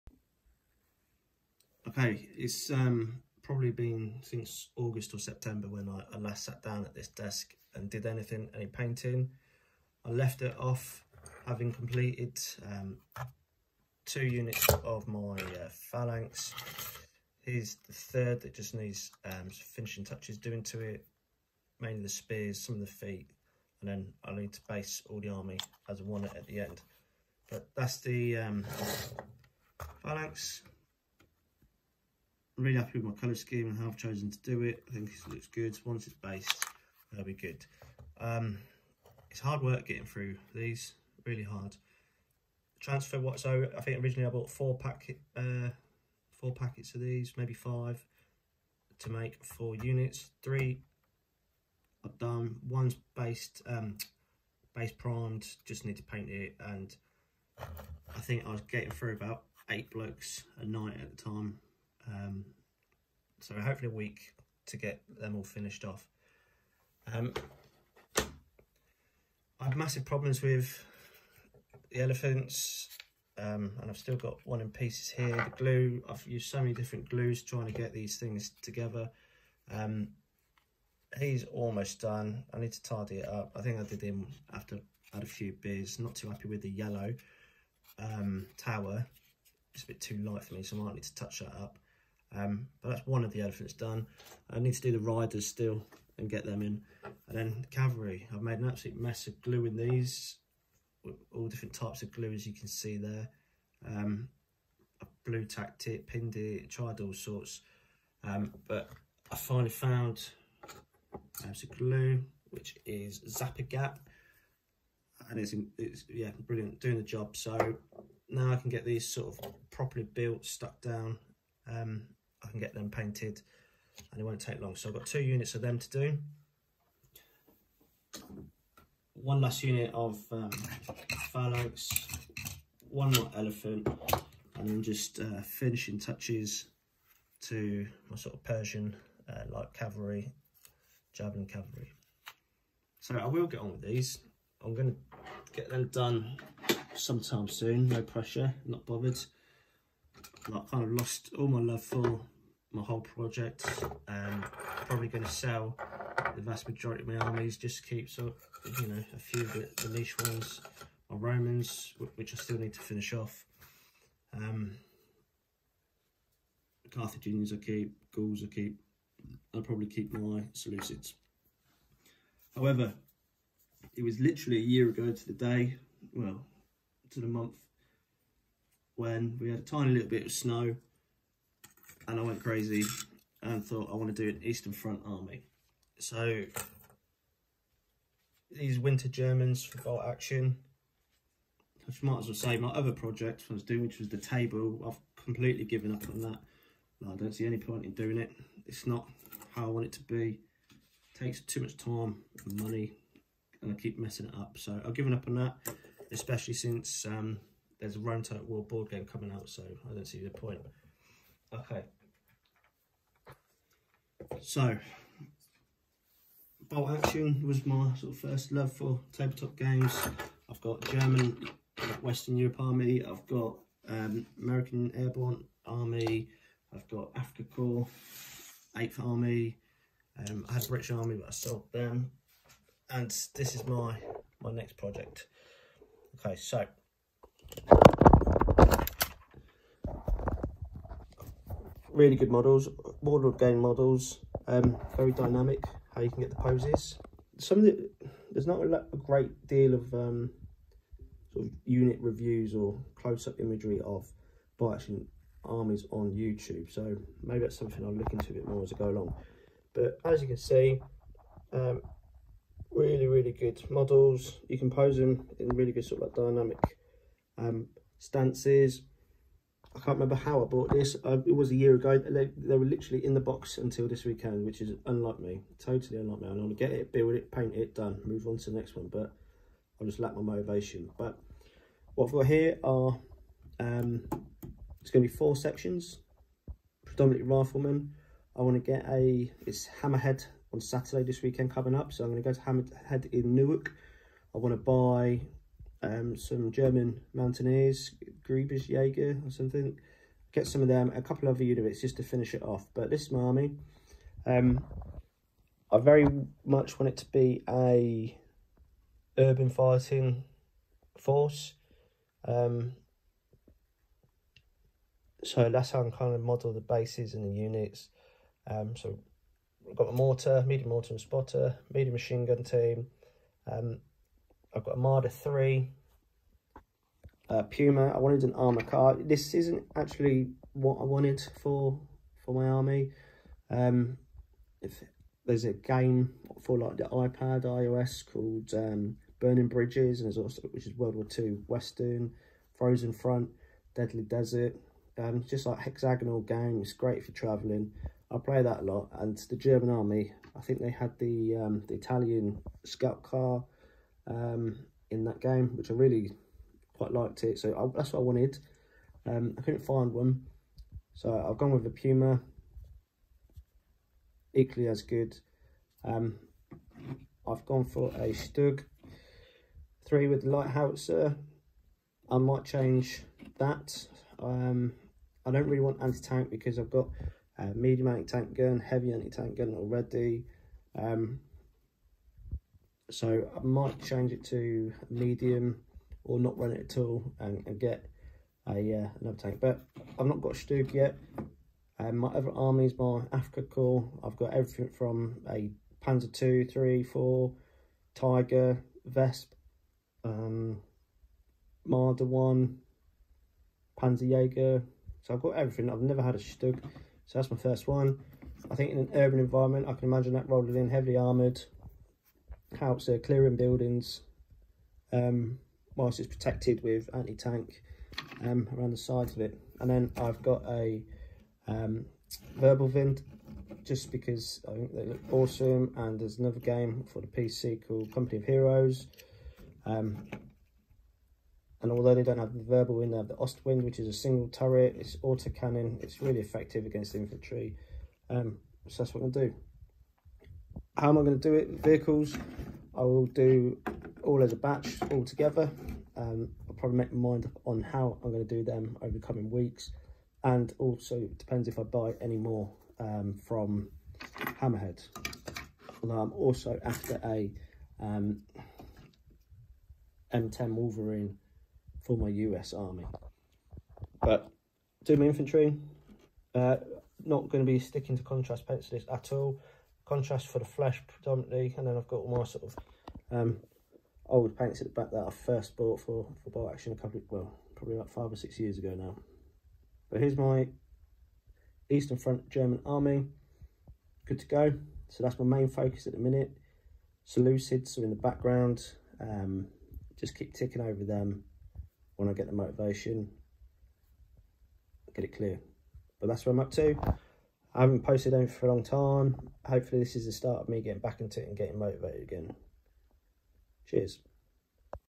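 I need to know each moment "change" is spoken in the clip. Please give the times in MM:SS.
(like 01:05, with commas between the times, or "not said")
06:12, 06:23.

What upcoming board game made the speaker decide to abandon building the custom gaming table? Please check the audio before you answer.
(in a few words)
Rome Total War.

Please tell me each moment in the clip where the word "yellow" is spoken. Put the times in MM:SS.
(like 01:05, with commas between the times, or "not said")
01:26.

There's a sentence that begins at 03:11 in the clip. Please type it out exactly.
I might as well say my other project I was doing, which was the table.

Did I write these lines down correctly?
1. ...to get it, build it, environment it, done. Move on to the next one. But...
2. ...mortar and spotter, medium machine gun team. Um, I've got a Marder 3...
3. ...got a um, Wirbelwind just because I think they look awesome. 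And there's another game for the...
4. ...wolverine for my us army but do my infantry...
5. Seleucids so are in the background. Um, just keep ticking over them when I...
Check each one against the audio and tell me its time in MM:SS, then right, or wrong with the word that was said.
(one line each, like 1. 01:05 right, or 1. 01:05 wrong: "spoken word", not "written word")
1. 04:36 wrong: "paint", not "environment"
2. 05:20 right
3. 07:00 right
4. 07:40 right
5. 08:07 right.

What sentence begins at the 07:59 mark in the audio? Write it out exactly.
But here's my Eastern Front German Army.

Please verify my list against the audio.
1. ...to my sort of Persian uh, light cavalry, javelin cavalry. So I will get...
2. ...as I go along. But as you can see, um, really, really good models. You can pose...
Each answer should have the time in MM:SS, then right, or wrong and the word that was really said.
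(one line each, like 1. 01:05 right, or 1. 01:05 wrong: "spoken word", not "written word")
1. 02:17 right
2. 04:18 right.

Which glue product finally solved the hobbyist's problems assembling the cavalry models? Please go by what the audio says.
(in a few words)
Zap-A-Gap.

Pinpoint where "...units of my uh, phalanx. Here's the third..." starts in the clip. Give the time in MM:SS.
00:14.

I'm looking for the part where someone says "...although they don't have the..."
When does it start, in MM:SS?
07:11.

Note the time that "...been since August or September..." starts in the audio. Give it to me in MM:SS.
00:03.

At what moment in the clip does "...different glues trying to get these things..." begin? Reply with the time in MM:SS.
01:16.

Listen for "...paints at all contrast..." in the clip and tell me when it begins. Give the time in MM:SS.
07:48.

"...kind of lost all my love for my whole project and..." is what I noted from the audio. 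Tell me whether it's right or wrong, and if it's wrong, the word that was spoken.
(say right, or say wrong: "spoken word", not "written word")
right.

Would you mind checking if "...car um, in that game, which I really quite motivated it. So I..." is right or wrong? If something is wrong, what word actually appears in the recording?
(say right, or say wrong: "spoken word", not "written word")
wrong: "liked", not "motivated".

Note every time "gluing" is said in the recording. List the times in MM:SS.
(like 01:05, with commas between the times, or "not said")
01:39.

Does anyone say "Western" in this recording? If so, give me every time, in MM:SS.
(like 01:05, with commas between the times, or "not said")
03:42, 05:41.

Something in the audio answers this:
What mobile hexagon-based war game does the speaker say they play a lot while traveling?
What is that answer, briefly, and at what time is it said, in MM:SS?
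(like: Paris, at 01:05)
Burning Bridges, at 05:39.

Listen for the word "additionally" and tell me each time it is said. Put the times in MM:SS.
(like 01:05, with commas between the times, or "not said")
not said.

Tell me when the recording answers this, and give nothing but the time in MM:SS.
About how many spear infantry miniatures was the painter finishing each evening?
00:59.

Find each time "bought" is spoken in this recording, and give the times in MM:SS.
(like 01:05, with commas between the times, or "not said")
00:44, 04:30, 07:55.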